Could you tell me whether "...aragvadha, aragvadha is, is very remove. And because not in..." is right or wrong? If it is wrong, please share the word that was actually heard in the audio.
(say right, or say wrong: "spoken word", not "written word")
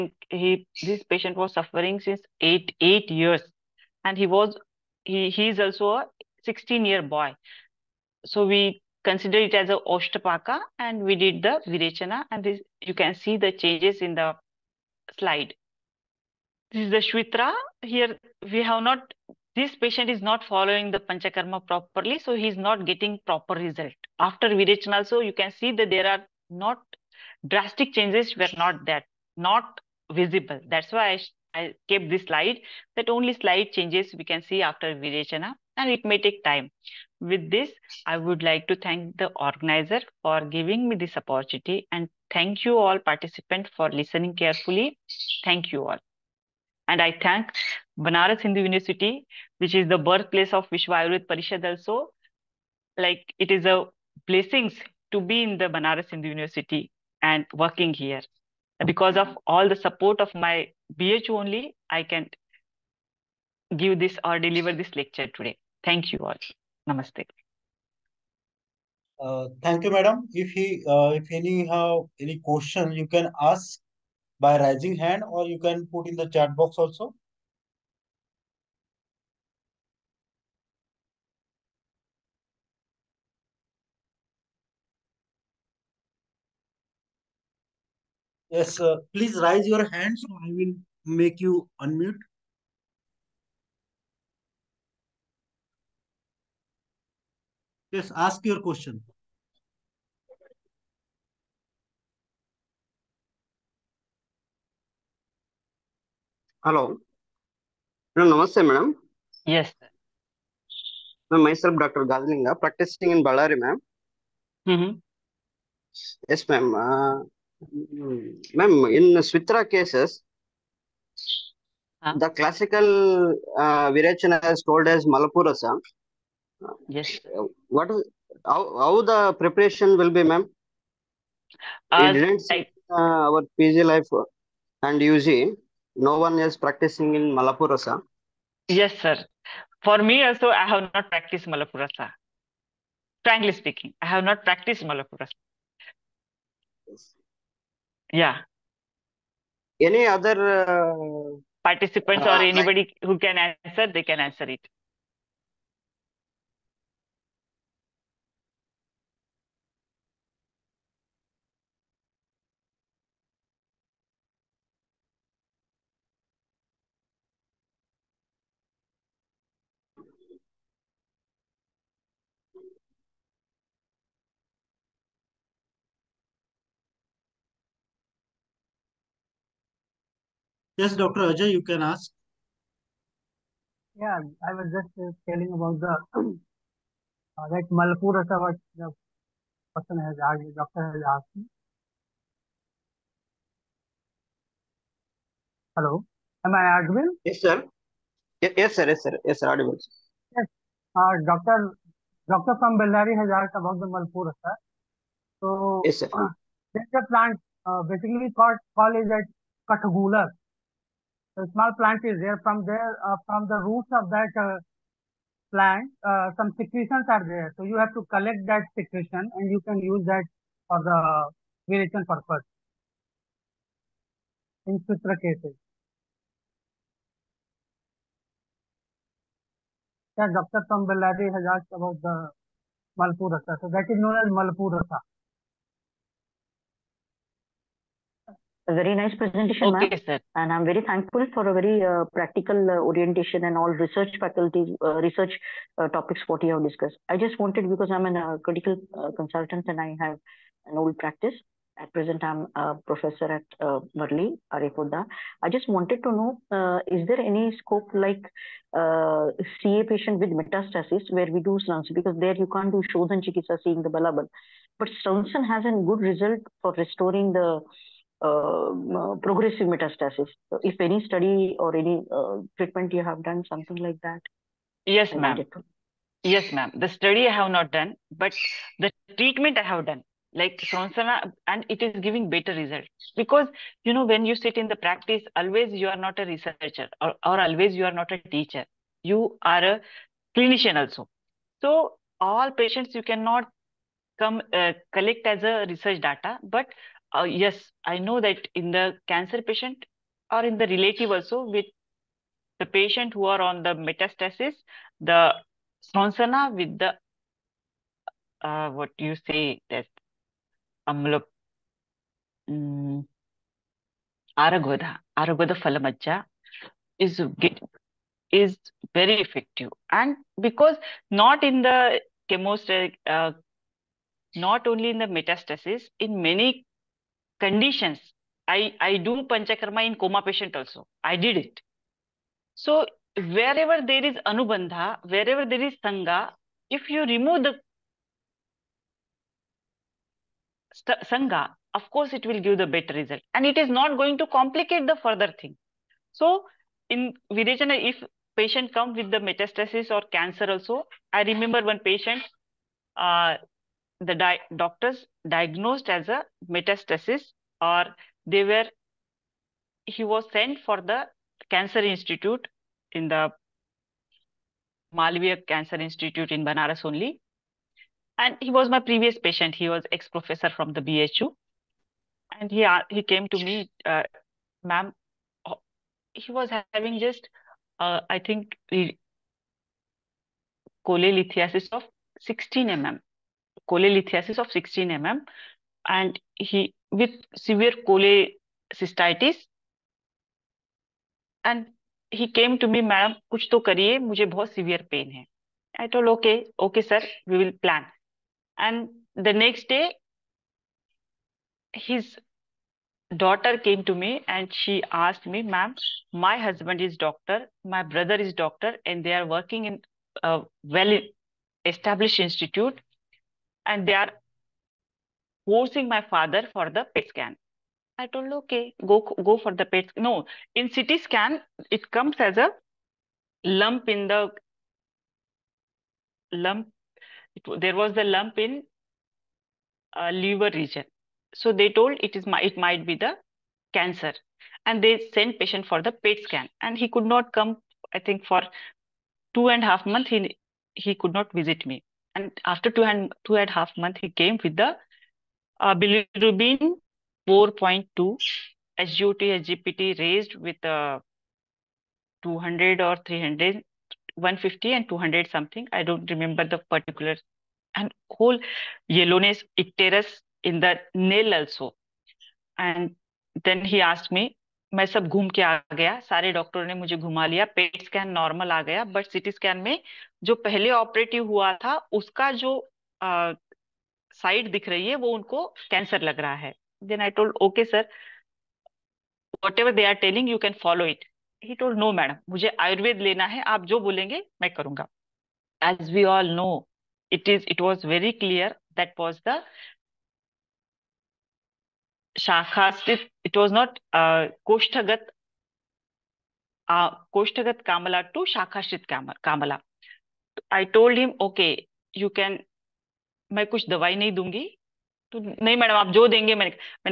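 wrong: "effective", not "remove".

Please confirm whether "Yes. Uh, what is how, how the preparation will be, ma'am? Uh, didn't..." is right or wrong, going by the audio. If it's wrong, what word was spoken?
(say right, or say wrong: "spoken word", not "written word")
right.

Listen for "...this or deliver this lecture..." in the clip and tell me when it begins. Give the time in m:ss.
1:03.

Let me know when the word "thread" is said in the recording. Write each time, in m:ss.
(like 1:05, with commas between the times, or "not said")
not said.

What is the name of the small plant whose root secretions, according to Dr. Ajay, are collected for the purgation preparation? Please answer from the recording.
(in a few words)
Katagula.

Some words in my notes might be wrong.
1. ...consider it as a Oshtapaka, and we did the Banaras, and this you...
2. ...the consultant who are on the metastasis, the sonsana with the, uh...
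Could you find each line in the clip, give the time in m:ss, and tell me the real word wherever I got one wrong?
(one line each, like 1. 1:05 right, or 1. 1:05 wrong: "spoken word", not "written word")
1. 0:09 wrong: "Virechana", not "Banaras"
2. 5:02 wrong: "patient", not "consultant".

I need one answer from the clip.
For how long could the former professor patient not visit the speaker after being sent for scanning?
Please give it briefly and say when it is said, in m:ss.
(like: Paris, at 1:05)
two and a half months, at 7:19.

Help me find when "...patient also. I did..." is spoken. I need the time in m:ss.
5:30.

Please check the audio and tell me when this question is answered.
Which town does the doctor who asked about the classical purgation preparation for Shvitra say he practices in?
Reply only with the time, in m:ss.
1:53.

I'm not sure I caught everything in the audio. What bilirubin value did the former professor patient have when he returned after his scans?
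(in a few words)
4.2.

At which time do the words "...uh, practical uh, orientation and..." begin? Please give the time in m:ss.
4:01.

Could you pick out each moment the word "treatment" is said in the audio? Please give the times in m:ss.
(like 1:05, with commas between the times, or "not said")
4:32, 4:39.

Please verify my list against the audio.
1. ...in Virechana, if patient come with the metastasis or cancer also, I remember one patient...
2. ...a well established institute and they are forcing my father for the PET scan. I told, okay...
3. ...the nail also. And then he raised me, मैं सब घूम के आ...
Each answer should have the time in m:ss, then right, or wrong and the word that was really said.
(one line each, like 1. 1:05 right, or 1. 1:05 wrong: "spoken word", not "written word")
1. 5:46 right
2. 6:50 right
3. 7:40 wrong: "asked", not "raised".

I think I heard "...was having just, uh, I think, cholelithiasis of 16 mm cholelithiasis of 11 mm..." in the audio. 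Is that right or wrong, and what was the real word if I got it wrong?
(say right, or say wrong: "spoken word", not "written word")
wrong: "16", not "11".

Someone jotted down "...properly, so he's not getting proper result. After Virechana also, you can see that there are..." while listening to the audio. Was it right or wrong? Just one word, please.
right.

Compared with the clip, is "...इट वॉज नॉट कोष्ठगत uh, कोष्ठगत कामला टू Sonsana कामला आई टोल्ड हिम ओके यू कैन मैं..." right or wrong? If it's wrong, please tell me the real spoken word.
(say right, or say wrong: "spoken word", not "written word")
wrong: "Kamala", not "Sonsana".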